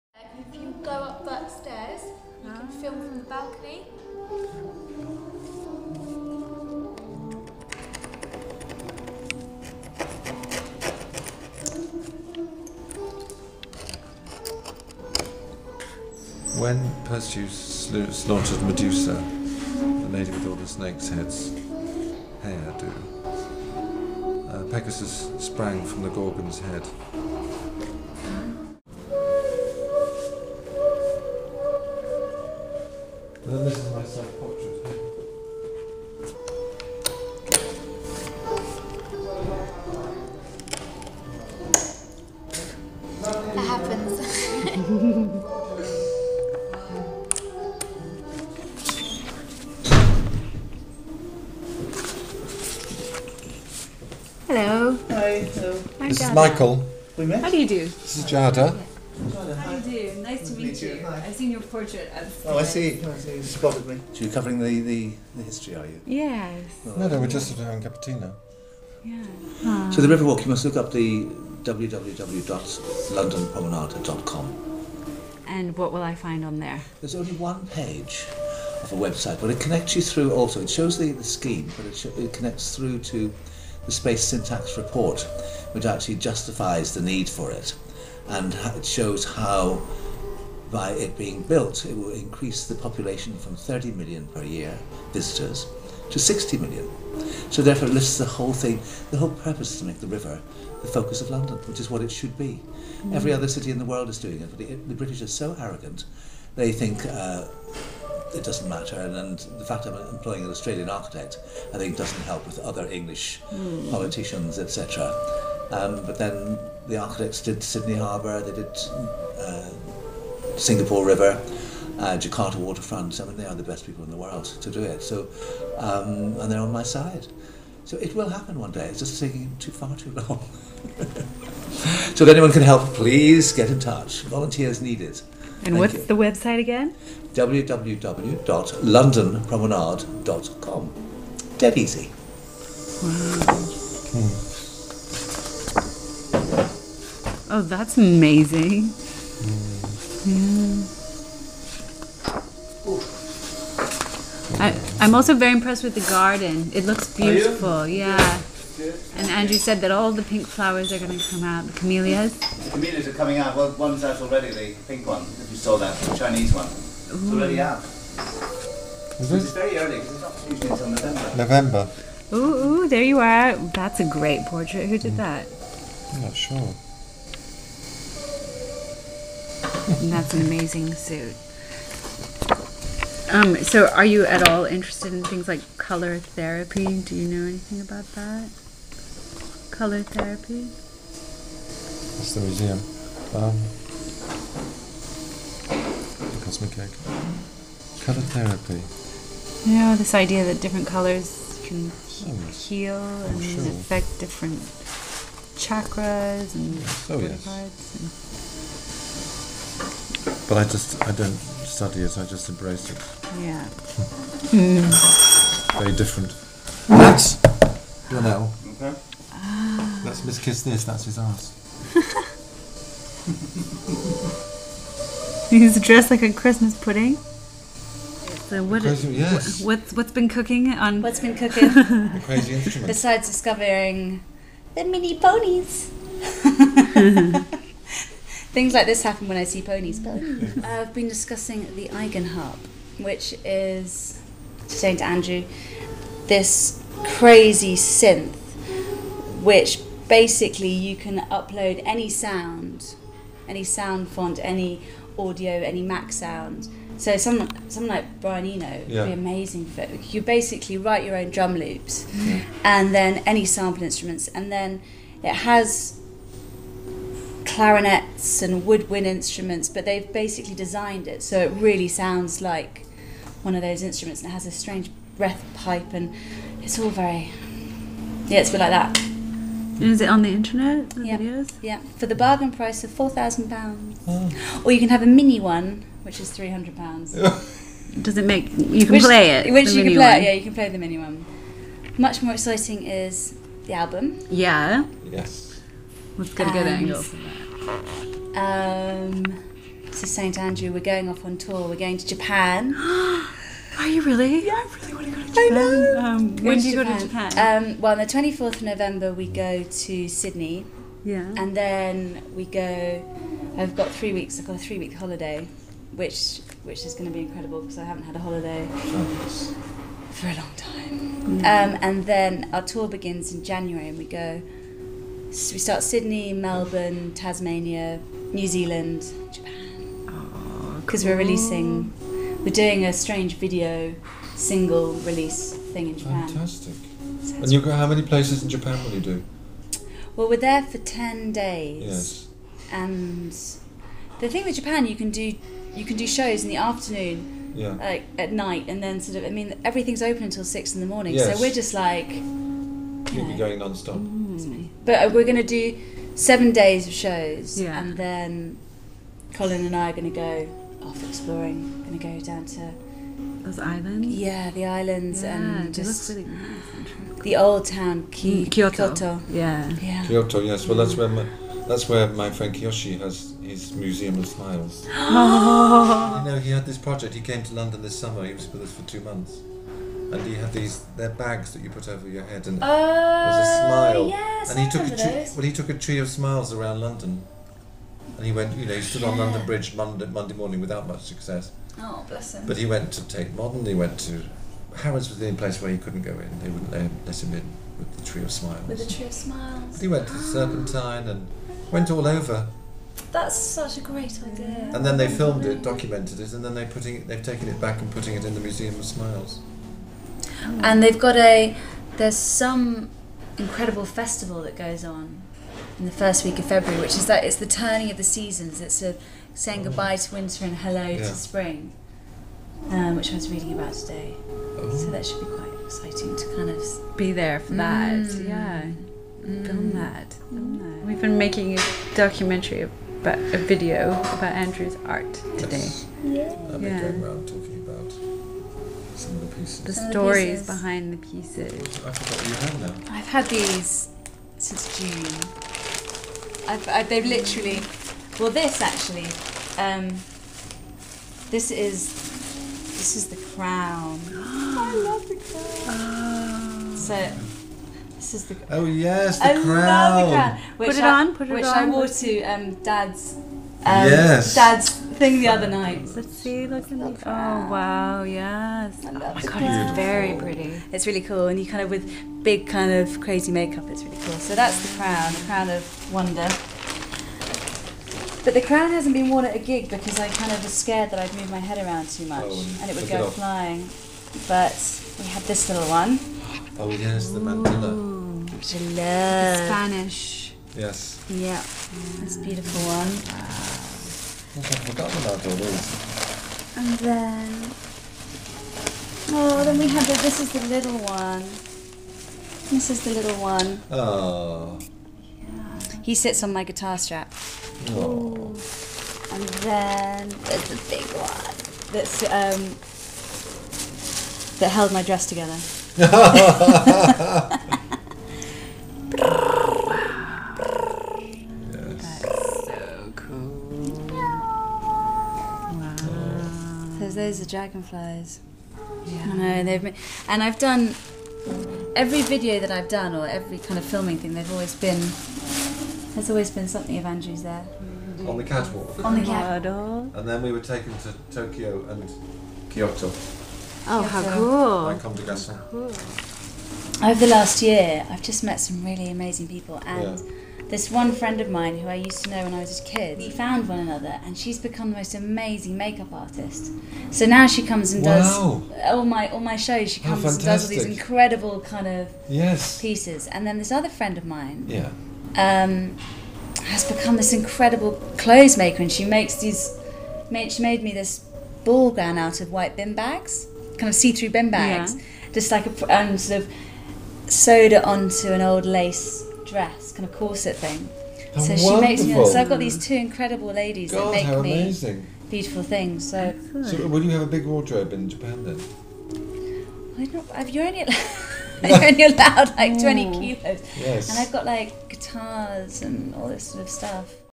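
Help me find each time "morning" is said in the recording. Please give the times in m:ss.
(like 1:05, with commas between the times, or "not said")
5:50, 6:30.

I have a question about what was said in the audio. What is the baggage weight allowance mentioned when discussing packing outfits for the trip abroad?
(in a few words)
20 kilos.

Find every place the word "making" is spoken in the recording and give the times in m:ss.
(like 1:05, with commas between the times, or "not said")
7:11.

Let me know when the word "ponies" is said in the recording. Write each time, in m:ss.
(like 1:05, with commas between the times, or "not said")
3:55, 3:59.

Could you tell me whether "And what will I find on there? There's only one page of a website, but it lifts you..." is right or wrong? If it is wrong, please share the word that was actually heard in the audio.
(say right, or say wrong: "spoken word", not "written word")
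wrong: "connects", not "lifts".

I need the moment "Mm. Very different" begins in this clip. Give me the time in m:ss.
3:34.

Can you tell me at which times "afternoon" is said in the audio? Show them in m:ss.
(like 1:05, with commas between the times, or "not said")
5:46.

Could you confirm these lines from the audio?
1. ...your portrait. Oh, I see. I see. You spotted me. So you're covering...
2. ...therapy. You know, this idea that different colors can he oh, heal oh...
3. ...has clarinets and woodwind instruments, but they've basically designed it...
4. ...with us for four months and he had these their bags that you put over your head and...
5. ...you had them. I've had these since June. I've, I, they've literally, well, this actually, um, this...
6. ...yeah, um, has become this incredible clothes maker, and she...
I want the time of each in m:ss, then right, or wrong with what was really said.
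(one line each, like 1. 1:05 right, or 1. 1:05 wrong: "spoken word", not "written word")
1. 1:01 right
2. 3:18 right
3. 4:25 right
4. 6:18 wrong: "two", not "four"
5. 7:22 right
6. 9:24 right.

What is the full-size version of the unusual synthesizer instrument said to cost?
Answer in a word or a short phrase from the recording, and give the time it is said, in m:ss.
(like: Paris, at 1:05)
4000 pounds, at 4:42.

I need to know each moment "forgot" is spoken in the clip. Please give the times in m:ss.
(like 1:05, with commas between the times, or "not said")
7:21.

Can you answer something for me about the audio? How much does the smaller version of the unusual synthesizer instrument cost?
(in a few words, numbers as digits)
300 pounds.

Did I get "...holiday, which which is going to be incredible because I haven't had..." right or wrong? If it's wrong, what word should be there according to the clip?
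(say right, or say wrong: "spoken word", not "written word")
right.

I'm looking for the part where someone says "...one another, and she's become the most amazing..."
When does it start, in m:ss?
9:13.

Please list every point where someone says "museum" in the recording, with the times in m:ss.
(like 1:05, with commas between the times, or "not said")
3:12, 6:13, 6:48.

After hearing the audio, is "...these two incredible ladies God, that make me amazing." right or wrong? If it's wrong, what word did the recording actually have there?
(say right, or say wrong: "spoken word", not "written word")
right.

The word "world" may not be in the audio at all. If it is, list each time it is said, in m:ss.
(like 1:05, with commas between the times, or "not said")
1:43, 2:04.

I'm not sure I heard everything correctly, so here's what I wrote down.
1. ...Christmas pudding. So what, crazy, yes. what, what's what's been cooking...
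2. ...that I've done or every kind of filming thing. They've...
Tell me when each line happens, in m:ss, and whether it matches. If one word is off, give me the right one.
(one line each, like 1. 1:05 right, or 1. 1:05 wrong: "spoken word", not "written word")
1. 3:46 right
2. 8:52 right.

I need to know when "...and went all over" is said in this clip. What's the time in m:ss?
6:41.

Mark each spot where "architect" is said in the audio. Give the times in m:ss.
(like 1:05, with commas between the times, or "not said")
1:50, 1:56.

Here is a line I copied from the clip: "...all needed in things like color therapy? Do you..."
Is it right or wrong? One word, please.
wrong.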